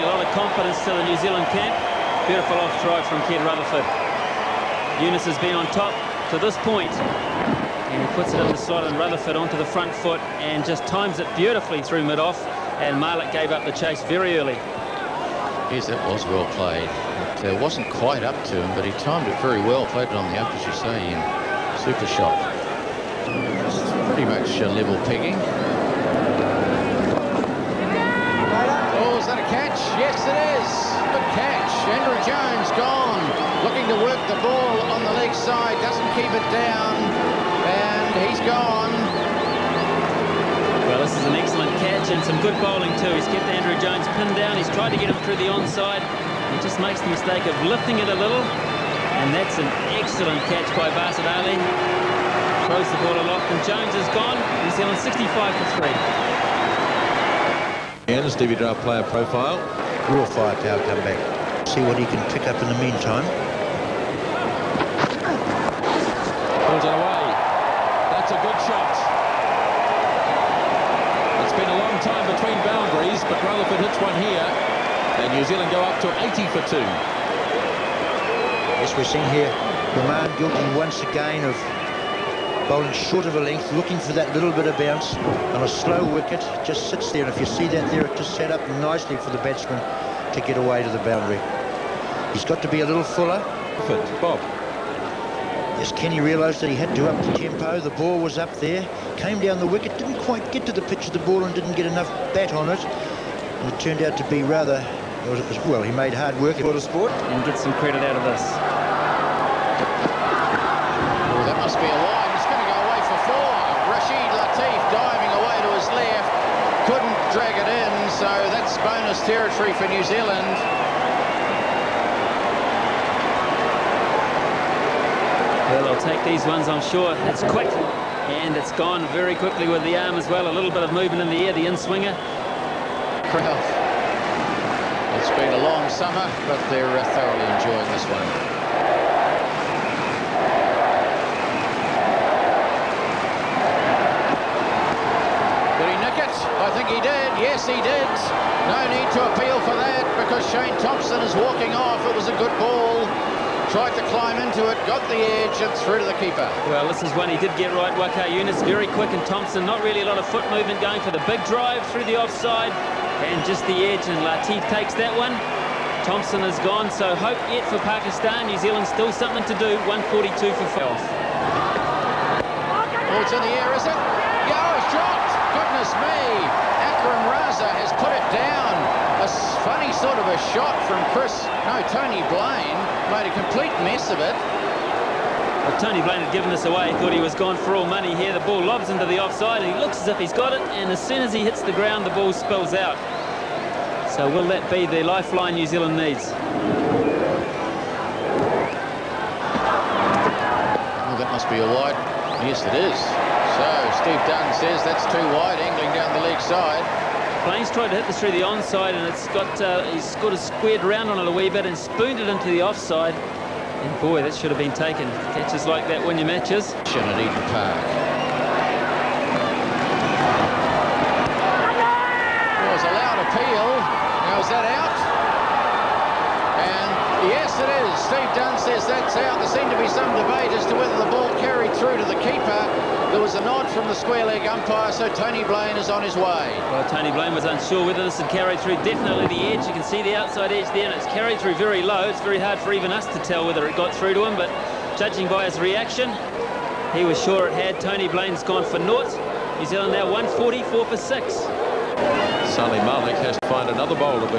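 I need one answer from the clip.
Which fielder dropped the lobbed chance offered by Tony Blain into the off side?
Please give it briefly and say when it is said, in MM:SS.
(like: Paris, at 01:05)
Akram Raza, at 02:56.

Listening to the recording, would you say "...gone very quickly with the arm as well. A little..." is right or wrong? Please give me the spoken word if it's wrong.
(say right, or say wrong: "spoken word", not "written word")
right.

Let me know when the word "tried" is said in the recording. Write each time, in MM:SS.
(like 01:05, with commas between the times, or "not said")
00:44, 02:33, 03:27.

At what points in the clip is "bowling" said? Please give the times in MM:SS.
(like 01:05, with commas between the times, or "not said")
00:42, 01:22.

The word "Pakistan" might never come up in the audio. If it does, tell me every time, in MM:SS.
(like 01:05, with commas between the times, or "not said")
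02:47.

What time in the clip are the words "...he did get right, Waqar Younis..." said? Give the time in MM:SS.
02:37.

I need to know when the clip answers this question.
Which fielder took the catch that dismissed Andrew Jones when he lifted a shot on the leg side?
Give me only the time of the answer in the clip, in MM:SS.
00:50.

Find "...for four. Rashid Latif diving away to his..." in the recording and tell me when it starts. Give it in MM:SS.
01:53.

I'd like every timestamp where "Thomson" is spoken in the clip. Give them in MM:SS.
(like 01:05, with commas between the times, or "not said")
02:30, 02:39, 02:46.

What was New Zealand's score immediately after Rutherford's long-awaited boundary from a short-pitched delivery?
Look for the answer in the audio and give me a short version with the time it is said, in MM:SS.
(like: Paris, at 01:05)
80 for 2, at 01:16.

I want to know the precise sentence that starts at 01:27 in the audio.
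And if you see that there, it just set up nicely for the batsman to get away to the boundary.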